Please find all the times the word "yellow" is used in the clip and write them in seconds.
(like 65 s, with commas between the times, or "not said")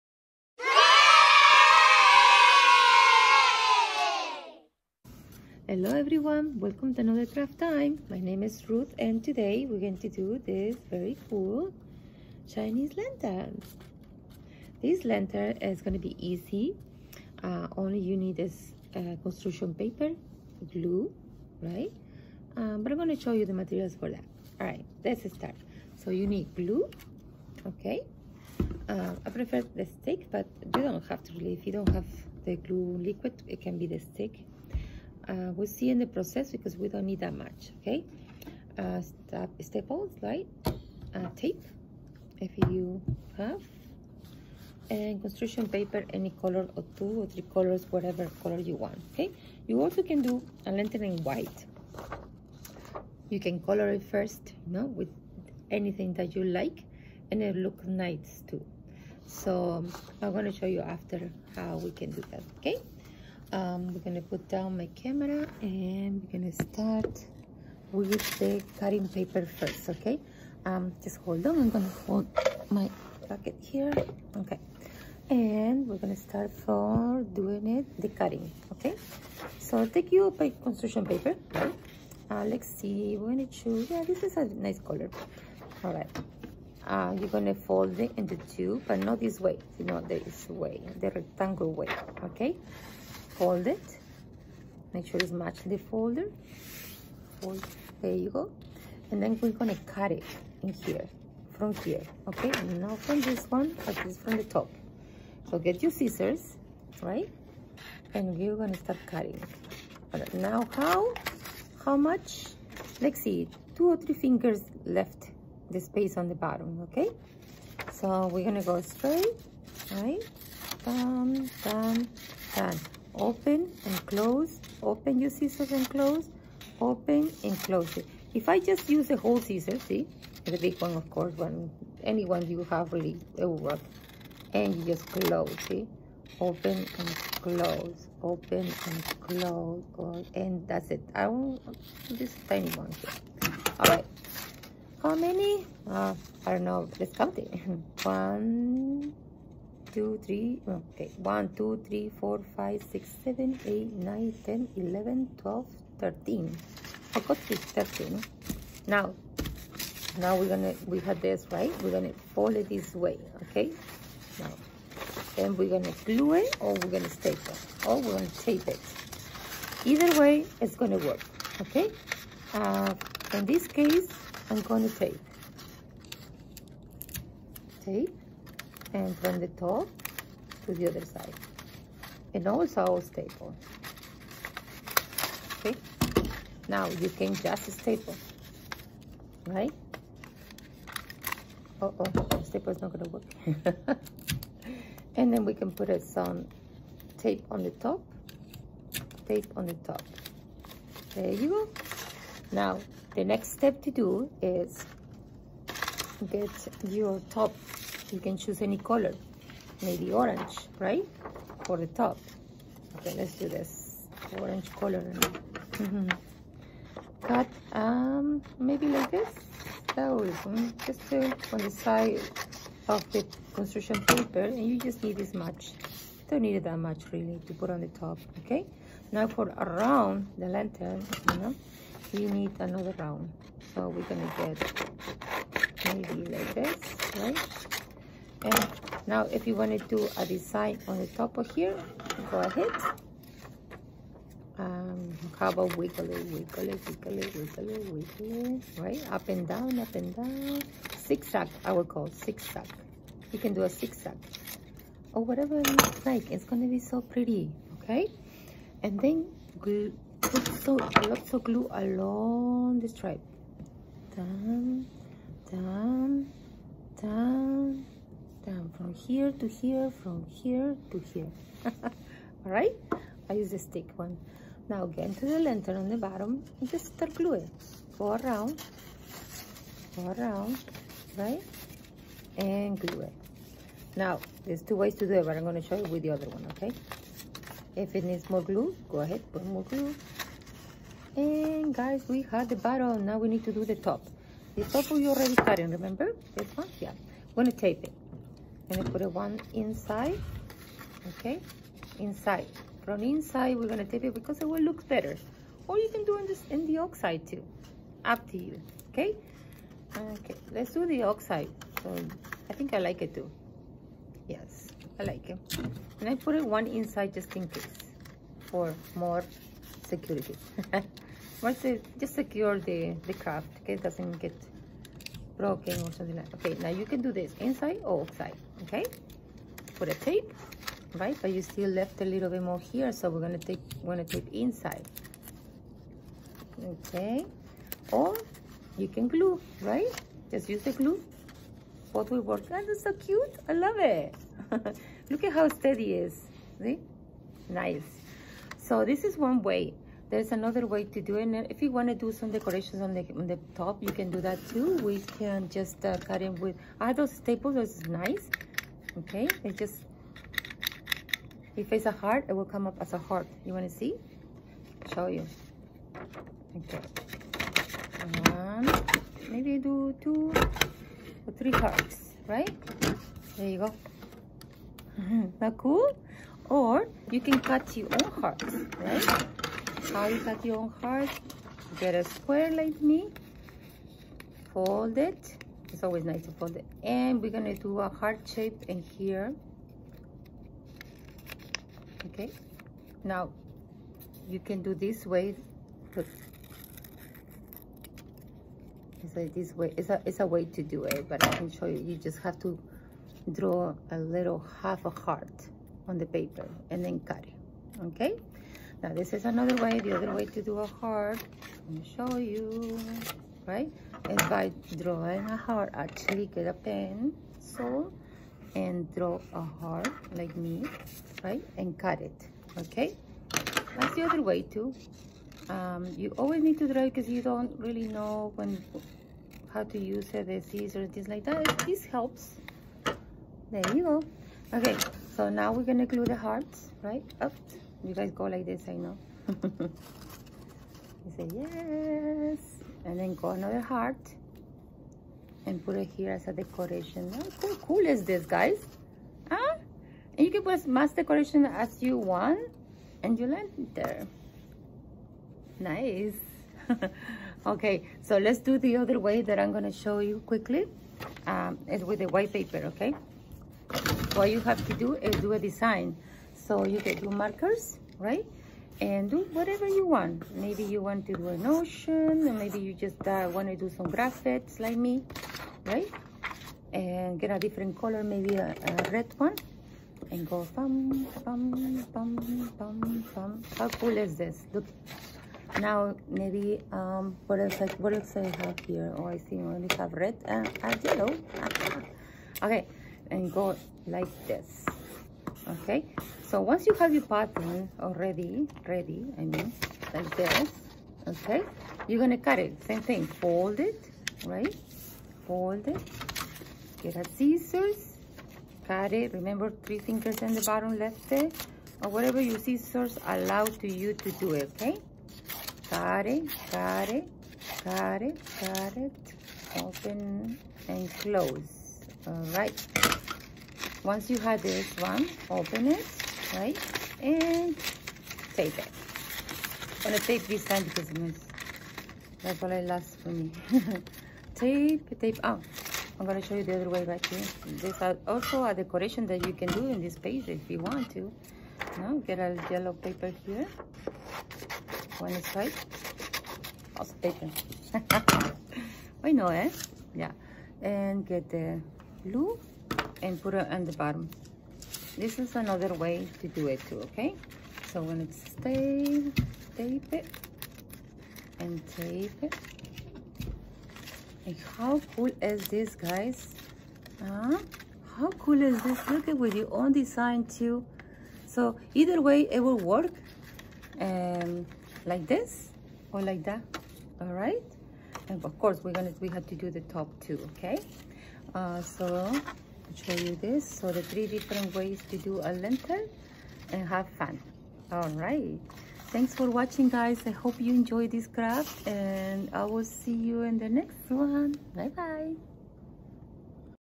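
490 s, 542 s.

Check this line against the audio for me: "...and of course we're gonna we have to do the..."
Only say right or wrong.
right.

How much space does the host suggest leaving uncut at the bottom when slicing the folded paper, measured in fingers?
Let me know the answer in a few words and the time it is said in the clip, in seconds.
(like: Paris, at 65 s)
two or three fingers, at 113 s.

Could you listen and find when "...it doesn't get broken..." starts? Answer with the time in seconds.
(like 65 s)
323 s.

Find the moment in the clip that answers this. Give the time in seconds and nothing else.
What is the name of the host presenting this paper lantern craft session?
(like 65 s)
8 s.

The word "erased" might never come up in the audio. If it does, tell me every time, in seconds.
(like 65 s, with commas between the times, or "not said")
not said.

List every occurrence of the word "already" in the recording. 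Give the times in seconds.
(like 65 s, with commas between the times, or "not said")
295 s, 497 s.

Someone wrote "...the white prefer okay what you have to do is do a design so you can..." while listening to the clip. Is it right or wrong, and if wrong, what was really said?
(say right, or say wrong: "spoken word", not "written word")
wrong: "paper", not "prefer".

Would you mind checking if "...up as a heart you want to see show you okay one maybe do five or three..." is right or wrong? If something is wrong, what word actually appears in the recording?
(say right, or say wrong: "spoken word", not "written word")
wrong: "two", not "five".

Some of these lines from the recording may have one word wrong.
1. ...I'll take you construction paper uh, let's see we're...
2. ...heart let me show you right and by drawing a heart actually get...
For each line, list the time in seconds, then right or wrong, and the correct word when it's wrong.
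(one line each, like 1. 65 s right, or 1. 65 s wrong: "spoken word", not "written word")
1. 79 s right
2. 410 s right.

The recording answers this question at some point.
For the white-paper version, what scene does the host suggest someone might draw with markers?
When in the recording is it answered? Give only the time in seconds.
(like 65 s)
471 s.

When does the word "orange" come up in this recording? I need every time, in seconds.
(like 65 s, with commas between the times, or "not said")
210 s, 214 s.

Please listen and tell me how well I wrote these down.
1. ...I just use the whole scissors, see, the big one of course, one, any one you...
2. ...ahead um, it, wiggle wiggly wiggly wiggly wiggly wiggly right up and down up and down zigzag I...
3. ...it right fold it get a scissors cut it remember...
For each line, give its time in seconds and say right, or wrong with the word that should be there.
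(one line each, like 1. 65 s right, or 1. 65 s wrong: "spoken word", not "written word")
1. 128 s right
2. 242 s right
3. 503 s right.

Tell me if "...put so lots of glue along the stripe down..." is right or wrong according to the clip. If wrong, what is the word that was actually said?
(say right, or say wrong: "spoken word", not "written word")
right.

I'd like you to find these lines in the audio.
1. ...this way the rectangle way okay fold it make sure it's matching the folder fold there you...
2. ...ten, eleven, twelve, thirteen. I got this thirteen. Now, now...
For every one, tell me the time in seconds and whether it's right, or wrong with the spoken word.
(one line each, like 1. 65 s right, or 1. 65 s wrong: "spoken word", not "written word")
1. 89 s right
2. 154 s right.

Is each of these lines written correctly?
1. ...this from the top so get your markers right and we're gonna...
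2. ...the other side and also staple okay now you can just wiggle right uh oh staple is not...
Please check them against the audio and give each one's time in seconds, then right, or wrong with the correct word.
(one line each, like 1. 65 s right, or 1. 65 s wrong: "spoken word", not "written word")
1. 104 s wrong: "scissors", not "markers"
2. 180 s wrong: "staple", not "wiggle".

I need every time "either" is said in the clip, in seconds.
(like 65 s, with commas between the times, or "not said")
169 s, 571 s.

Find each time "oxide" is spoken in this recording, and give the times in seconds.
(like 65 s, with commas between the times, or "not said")
306 s, 311 s.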